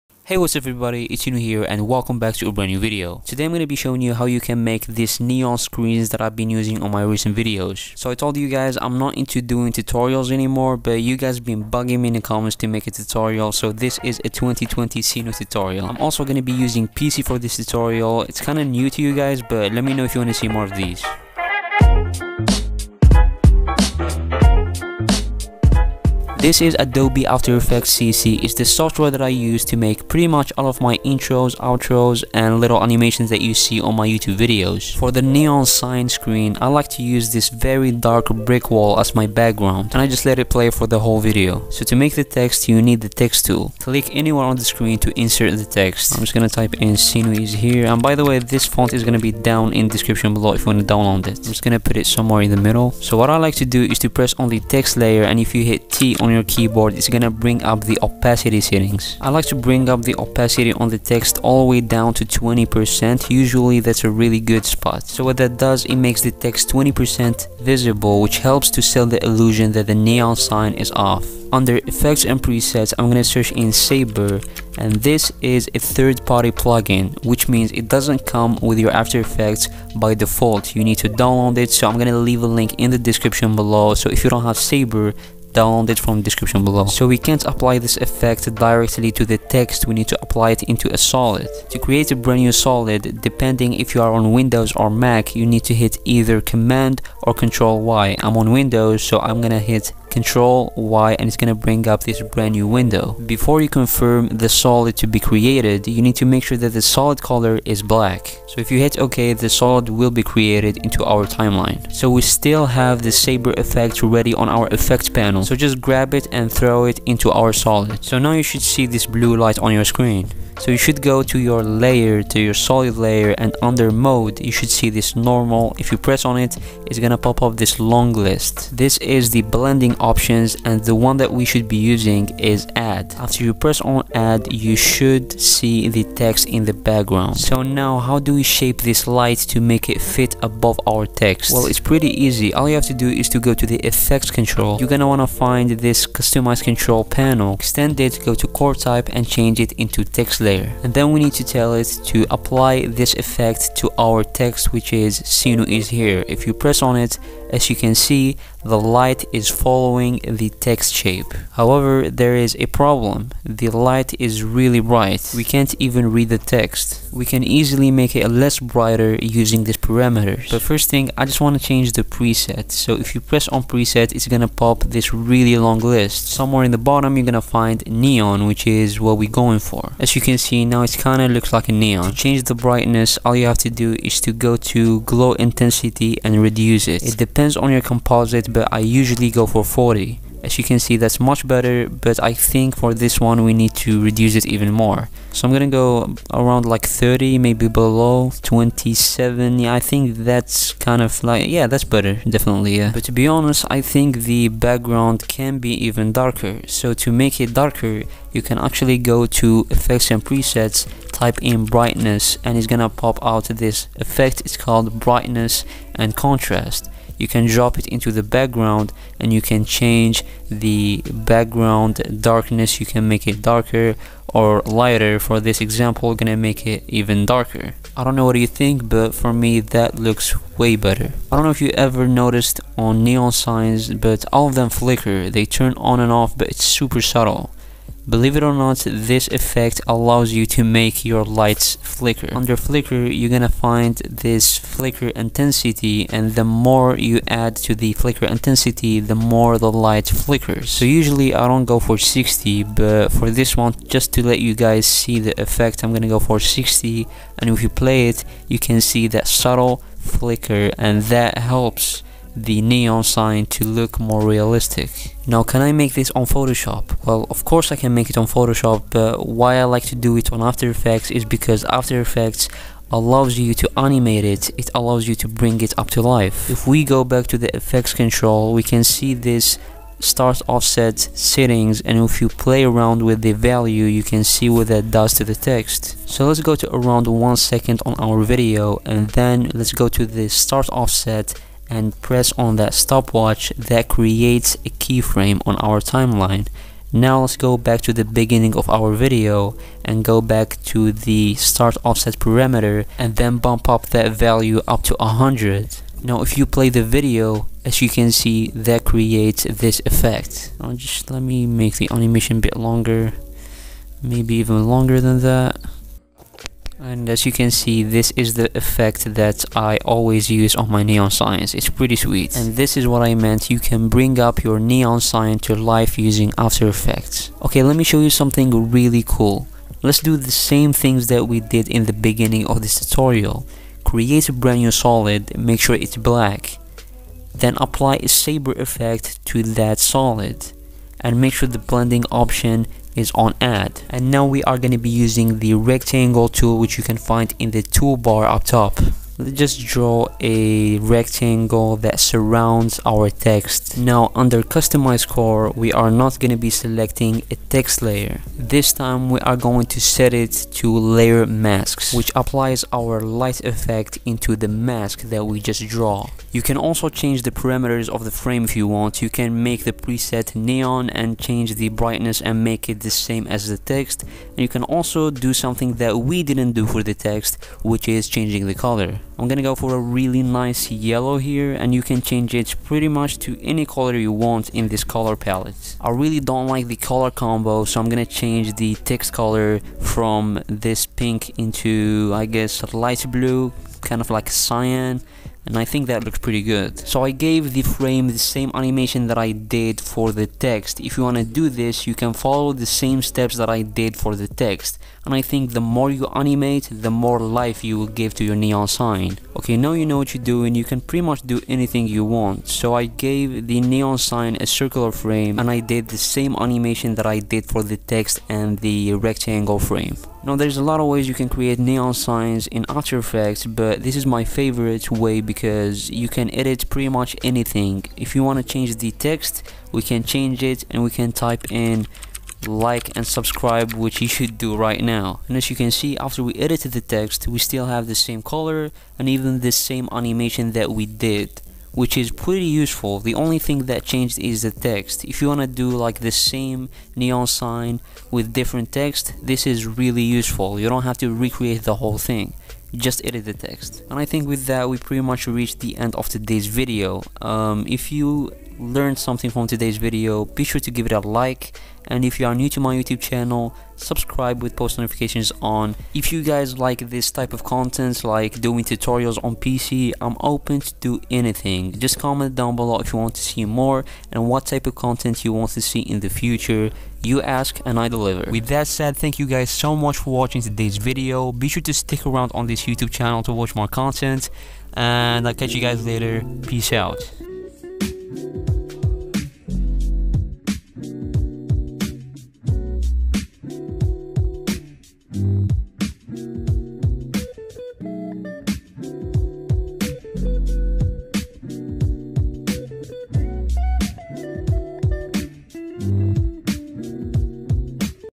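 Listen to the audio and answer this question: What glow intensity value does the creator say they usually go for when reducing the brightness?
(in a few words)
40.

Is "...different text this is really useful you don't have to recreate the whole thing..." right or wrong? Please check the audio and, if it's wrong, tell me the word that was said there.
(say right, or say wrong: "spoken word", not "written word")
right.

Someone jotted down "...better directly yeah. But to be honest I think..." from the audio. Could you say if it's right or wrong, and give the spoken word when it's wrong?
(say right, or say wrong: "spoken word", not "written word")
wrong: "definitely", not "directly".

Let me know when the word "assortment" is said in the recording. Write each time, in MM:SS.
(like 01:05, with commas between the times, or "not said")
not said.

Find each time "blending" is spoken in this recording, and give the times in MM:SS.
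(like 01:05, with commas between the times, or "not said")
02:09, 05:41.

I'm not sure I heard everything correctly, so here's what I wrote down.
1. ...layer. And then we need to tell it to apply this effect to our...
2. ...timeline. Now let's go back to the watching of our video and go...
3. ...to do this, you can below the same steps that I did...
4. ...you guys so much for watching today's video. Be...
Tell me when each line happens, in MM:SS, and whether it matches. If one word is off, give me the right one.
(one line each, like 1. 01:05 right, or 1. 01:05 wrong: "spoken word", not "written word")
1. 02:30 right
2. 04:55 wrong: "beginning", not "watching"
3. 06:41 wrong: "follow", not "below"
4. 07:59 right.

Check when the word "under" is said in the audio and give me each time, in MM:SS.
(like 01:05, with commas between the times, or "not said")
01:11, 02:03, 04:02, 05:54.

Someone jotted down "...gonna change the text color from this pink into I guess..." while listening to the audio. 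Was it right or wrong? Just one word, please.
right.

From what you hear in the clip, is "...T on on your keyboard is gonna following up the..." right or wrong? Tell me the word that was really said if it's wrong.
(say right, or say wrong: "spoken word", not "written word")
wrong: "bring", not "following".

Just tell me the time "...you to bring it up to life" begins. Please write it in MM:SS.
04:35.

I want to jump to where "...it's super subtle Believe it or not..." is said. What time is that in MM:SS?
03:56.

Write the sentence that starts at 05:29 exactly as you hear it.
Let's do the same things that we did in the beginning of this tutorial.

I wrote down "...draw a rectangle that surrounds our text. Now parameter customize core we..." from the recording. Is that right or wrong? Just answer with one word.
wrong.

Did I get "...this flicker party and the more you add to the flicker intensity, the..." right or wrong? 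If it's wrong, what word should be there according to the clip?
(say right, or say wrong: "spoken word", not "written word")
wrong: "intensity", not "party".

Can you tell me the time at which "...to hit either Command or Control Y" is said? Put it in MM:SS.
01:35.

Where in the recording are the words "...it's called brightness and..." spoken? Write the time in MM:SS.
03:34.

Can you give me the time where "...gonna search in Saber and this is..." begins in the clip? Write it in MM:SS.
01:13.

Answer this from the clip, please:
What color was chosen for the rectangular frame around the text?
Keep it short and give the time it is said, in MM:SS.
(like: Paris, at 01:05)
Yellow, at 06:20.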